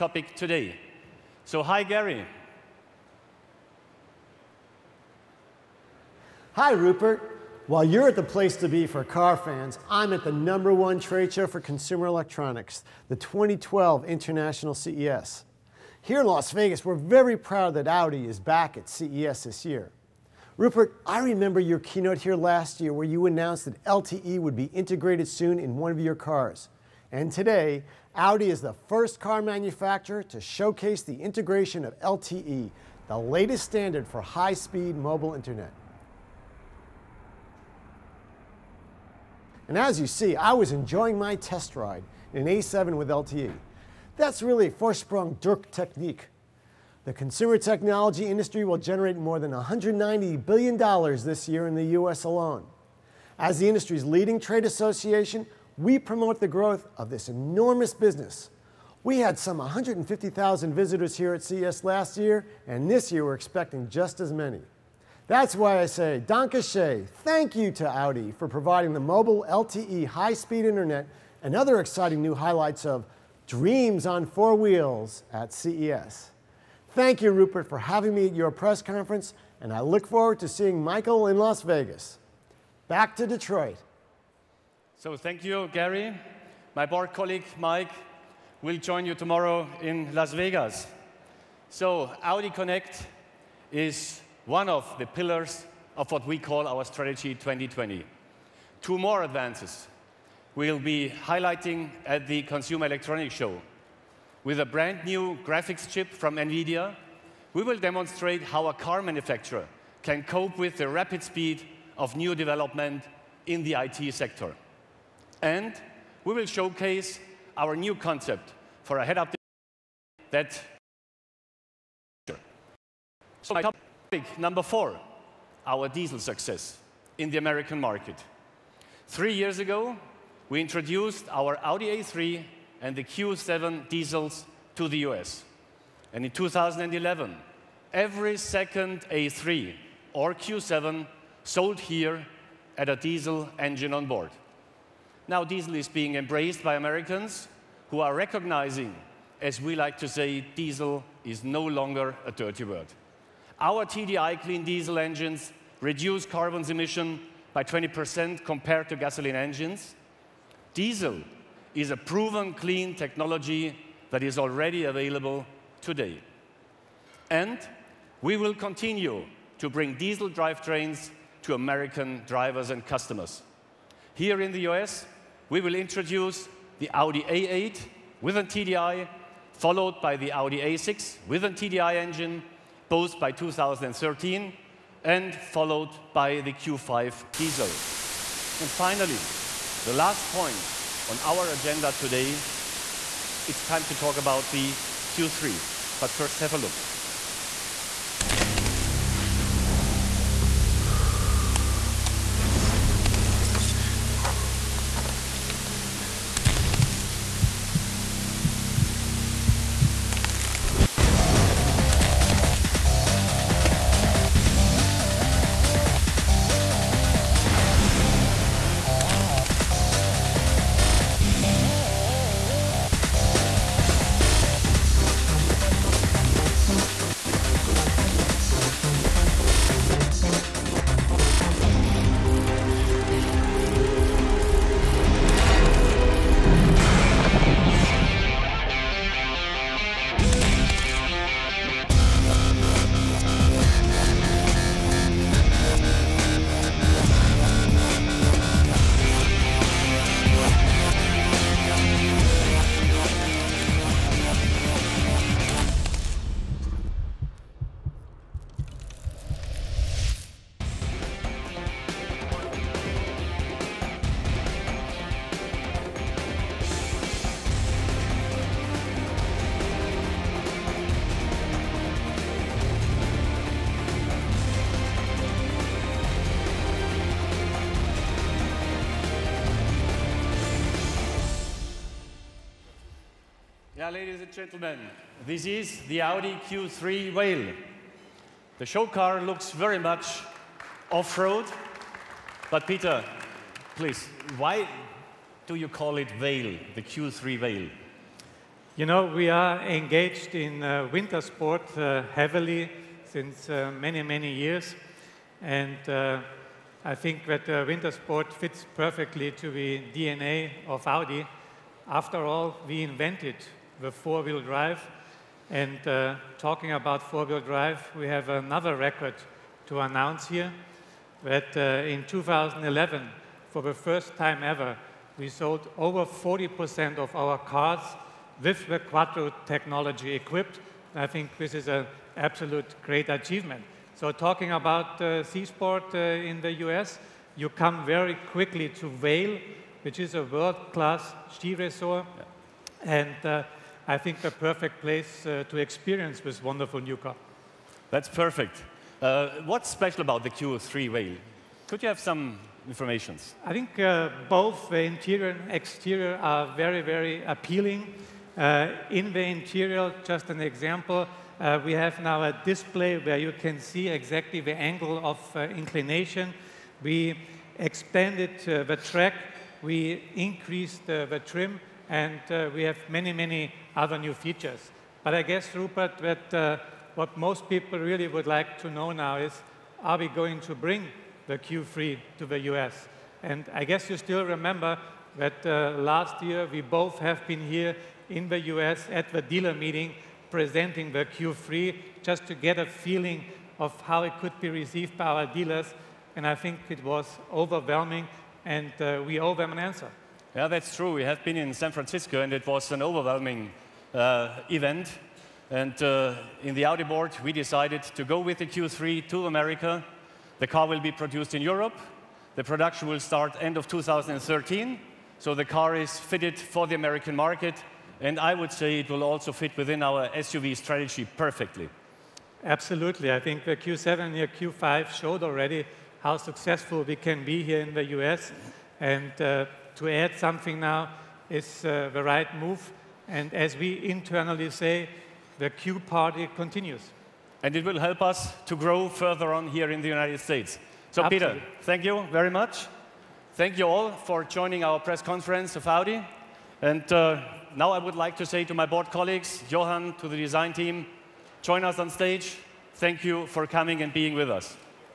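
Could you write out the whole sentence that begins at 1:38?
Two more advances we will be highlighting at the Consumer Electronics Show.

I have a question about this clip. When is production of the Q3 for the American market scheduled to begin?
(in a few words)
End of 2013.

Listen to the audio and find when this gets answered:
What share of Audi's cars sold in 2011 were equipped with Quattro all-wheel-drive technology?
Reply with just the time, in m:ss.
5:25.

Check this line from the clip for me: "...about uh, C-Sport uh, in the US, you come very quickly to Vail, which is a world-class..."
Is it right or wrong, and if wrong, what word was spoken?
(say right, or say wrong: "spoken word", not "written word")
right.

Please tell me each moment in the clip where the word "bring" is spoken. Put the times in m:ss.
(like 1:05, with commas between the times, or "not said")
2:49, 6:20.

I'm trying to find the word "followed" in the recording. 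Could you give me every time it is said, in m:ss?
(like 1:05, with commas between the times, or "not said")
2:59, 3:05.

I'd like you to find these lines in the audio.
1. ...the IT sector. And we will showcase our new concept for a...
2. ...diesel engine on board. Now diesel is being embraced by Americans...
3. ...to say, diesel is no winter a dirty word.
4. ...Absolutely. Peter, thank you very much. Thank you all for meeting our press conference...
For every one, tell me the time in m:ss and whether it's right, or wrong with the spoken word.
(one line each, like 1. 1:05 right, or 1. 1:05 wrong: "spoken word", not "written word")
1. 1:53 right
2. 2:22 right
3. 2:29 wrong: "longer", not "winter"
4. 7:21 wrong: "joining", not "meeting".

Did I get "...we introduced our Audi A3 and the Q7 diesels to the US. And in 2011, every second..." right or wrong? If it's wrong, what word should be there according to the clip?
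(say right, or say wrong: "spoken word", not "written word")
right.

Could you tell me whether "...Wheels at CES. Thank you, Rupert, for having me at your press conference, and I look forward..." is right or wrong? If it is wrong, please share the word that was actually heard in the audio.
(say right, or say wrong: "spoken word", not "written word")
right.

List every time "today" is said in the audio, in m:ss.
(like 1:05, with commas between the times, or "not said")
0:00, 0:27, 2:45, 3:11.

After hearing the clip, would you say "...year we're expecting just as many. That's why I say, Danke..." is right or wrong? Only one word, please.
right.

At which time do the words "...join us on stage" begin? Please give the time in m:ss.
7:31.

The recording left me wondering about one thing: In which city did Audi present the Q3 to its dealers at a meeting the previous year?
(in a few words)
San Francisco.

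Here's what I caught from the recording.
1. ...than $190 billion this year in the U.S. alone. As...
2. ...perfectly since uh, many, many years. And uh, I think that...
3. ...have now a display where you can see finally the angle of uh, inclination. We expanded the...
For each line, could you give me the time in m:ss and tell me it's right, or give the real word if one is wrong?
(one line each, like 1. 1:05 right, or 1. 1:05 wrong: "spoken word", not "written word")
1. 0:49 right
2. 5:02 wrong: "heavily", not "perfectly"
3. 6:01 wrong: "exactly", not "finally".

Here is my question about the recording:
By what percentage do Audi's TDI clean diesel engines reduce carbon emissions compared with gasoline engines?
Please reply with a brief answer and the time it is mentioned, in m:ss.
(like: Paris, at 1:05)
20%, at 2:37.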